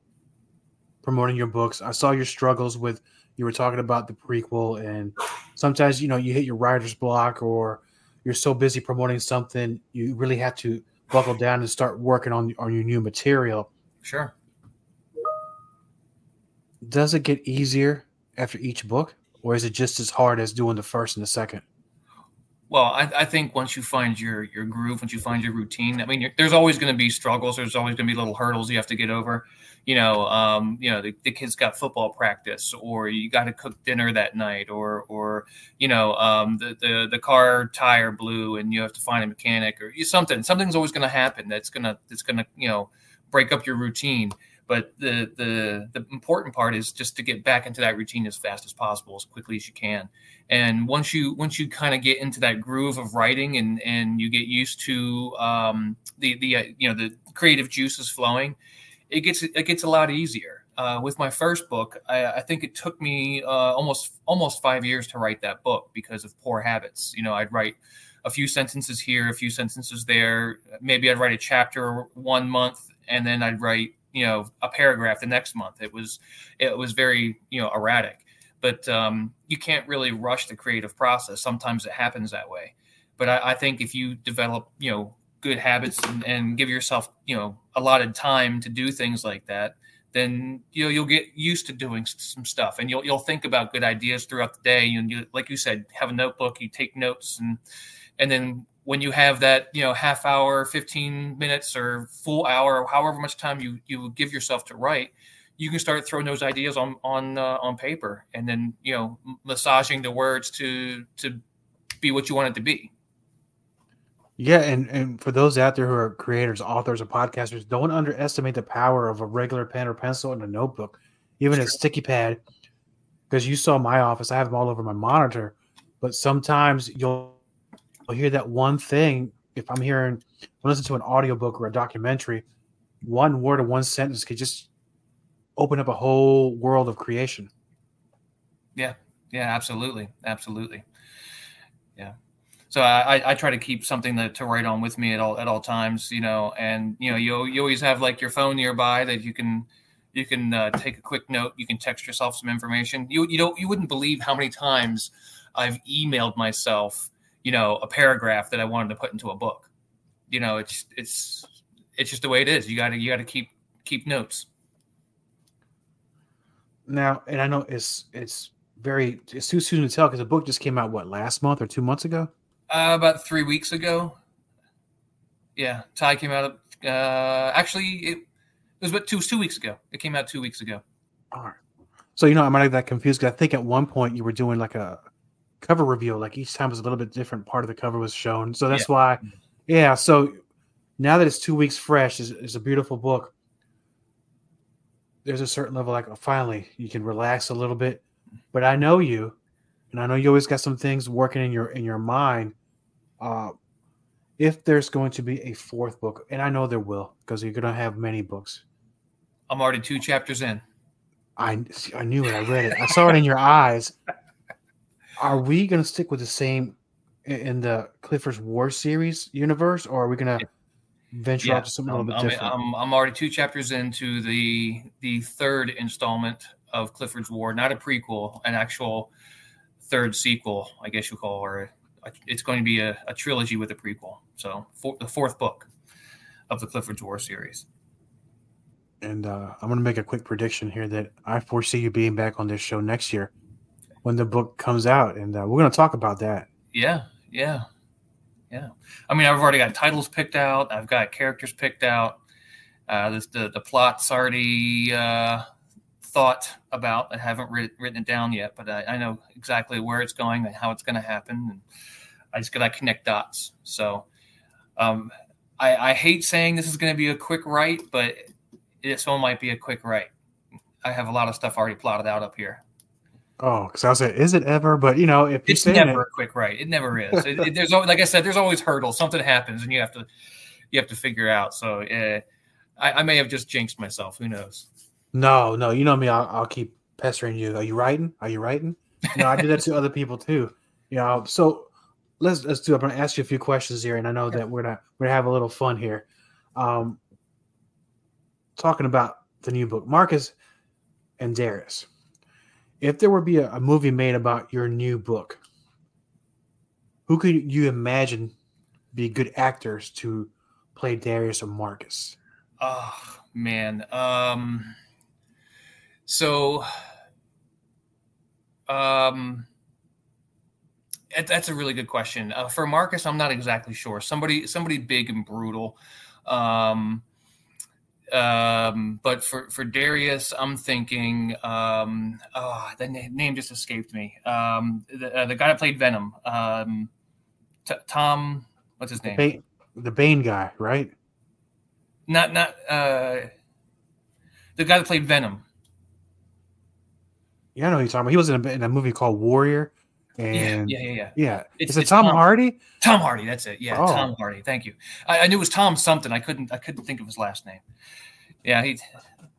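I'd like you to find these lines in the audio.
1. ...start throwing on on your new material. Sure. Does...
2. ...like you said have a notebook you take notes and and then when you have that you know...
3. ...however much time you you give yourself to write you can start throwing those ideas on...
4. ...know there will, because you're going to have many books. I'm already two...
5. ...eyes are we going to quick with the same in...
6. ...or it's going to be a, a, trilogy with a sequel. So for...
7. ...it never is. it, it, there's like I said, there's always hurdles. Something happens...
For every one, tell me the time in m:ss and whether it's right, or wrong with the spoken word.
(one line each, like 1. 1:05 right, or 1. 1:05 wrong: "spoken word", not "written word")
1. 0:11 wrong: "working", not "throwing"
2. 1:35 right
3. 1:42 right
4. 3:26 right
5. 3:33 wrong: "stick", not "quick"
6. 3:51 wrong: "prequel", not "sequel"
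7. 4:36 right.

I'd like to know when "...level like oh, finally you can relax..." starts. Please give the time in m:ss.
3:15.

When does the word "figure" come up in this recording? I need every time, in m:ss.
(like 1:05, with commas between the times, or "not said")
4:40.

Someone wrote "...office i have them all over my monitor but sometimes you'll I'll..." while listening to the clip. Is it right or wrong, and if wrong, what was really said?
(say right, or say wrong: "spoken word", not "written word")
right.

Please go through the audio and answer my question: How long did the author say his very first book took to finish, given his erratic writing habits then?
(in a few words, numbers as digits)
almost 5 years.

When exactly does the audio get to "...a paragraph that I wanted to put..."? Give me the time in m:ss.
2:37.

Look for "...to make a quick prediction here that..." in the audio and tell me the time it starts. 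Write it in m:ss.
3:59.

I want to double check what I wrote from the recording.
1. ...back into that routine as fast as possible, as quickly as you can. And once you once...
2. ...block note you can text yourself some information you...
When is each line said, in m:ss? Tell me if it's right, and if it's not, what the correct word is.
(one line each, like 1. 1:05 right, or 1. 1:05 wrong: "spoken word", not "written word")
1. 0:47 right
2. 2:31 wrong: "quick", not "block".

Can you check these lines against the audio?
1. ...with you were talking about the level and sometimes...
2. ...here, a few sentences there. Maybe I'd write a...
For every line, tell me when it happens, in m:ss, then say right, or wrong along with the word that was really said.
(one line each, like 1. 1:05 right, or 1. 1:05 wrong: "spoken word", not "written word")
1. 0:02 wrong: "prequel", not "level"
2. 1:09 right.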